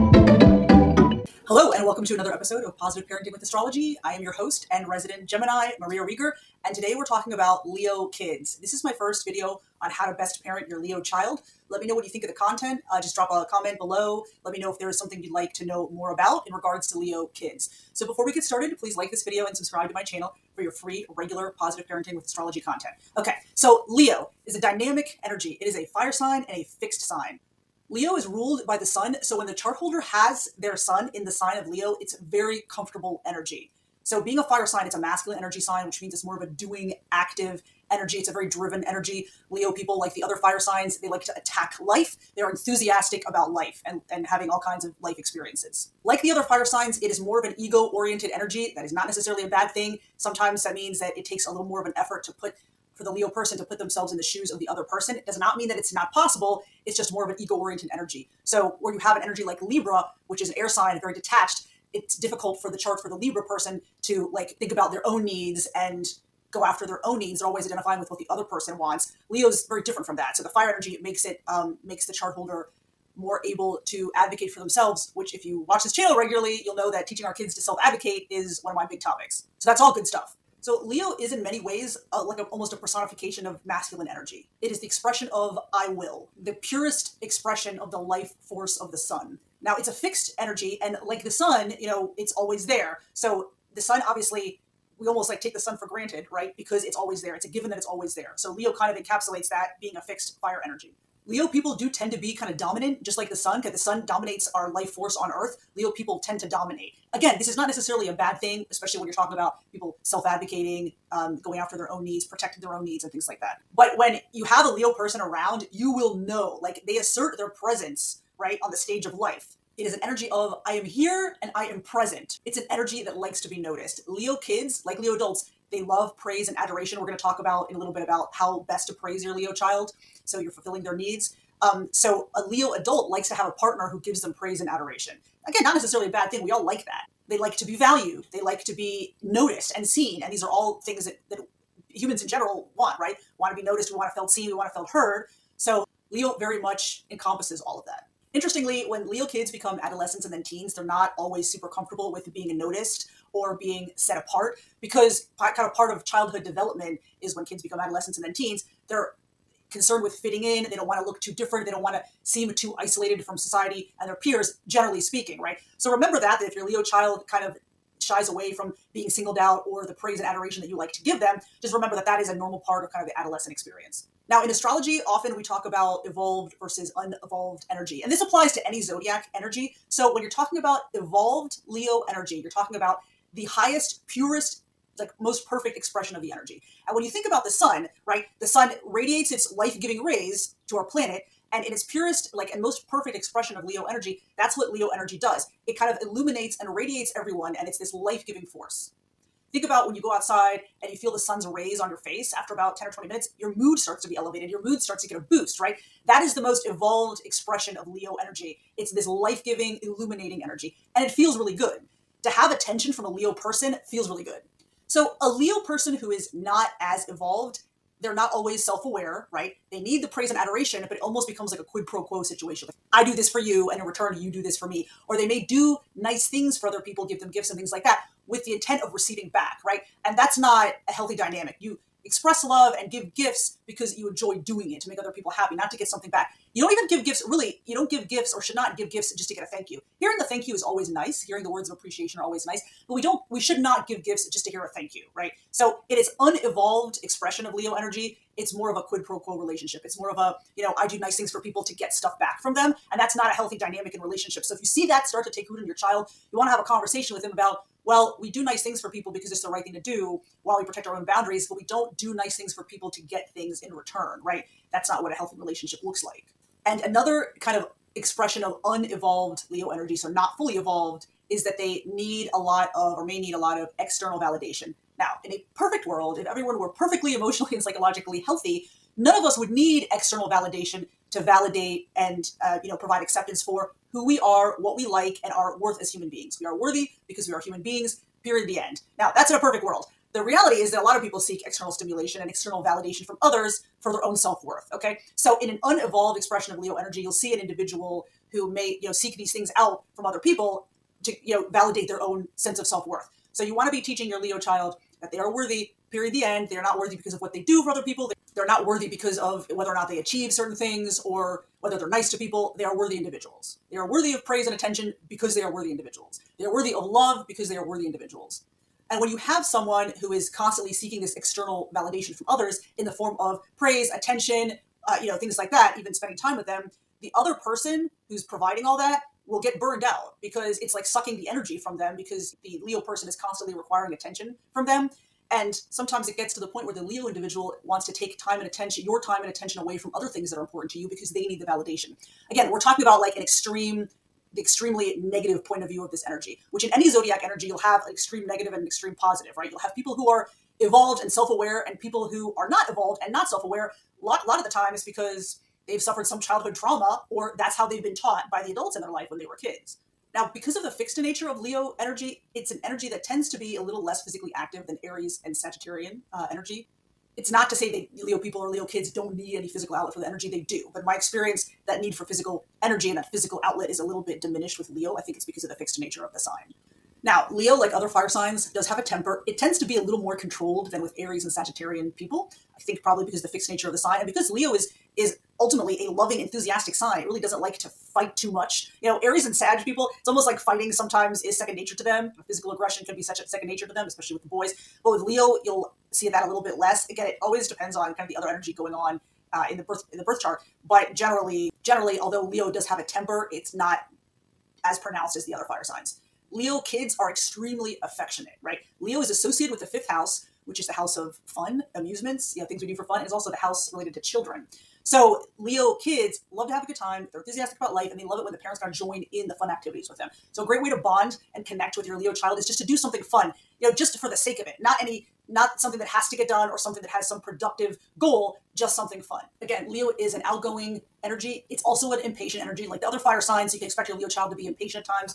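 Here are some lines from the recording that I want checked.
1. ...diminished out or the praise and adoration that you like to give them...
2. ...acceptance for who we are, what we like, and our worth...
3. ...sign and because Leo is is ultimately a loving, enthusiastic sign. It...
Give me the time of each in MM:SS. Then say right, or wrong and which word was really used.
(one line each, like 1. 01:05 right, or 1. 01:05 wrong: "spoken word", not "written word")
1. 02:49 wrong: "singled", not "diminished"
2. 04:43 right
3. 06:23 right.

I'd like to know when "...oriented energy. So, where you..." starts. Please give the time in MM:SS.
00:57.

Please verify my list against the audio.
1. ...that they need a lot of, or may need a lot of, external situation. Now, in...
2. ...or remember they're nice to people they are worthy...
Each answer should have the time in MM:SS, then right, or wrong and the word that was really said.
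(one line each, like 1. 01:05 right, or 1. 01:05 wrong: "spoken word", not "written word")
1. 04:31 wrong: "validation", not "situation"
2. 05:11 wrong: "whether", not "remember".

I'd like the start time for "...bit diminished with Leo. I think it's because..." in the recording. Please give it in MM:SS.
06:14.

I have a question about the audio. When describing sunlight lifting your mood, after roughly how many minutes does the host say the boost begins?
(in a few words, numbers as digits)
10 or 20 minutes.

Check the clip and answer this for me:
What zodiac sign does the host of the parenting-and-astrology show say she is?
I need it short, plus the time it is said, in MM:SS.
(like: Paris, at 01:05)
Gemini, at 00:05.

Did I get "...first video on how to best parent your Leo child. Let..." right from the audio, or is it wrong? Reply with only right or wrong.
right.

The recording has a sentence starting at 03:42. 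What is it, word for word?
Like, I do this for you, and in return, you do this for me.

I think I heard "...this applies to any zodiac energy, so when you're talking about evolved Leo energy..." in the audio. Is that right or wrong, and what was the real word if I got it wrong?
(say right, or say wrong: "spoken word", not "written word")
right.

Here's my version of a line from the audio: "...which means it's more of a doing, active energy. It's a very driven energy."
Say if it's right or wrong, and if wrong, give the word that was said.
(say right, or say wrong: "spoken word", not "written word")
right.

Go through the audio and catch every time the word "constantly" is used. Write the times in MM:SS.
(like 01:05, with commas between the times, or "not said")
05:20, 05:33.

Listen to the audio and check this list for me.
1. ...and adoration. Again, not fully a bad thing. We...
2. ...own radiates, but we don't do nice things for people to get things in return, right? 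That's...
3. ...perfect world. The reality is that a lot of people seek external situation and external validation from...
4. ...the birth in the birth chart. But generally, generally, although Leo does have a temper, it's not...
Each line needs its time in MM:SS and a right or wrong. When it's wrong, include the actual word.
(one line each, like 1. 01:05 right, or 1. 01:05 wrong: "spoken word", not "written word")
1. 02:14 wrong: "necessarily", not "fully"
2. 04:20 wrong: "boundaries", not "radiates"
3. 04:49 wrong: "stimulation", not "situation"
4. 06:39 right.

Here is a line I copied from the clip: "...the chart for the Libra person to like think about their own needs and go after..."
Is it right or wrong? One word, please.
right.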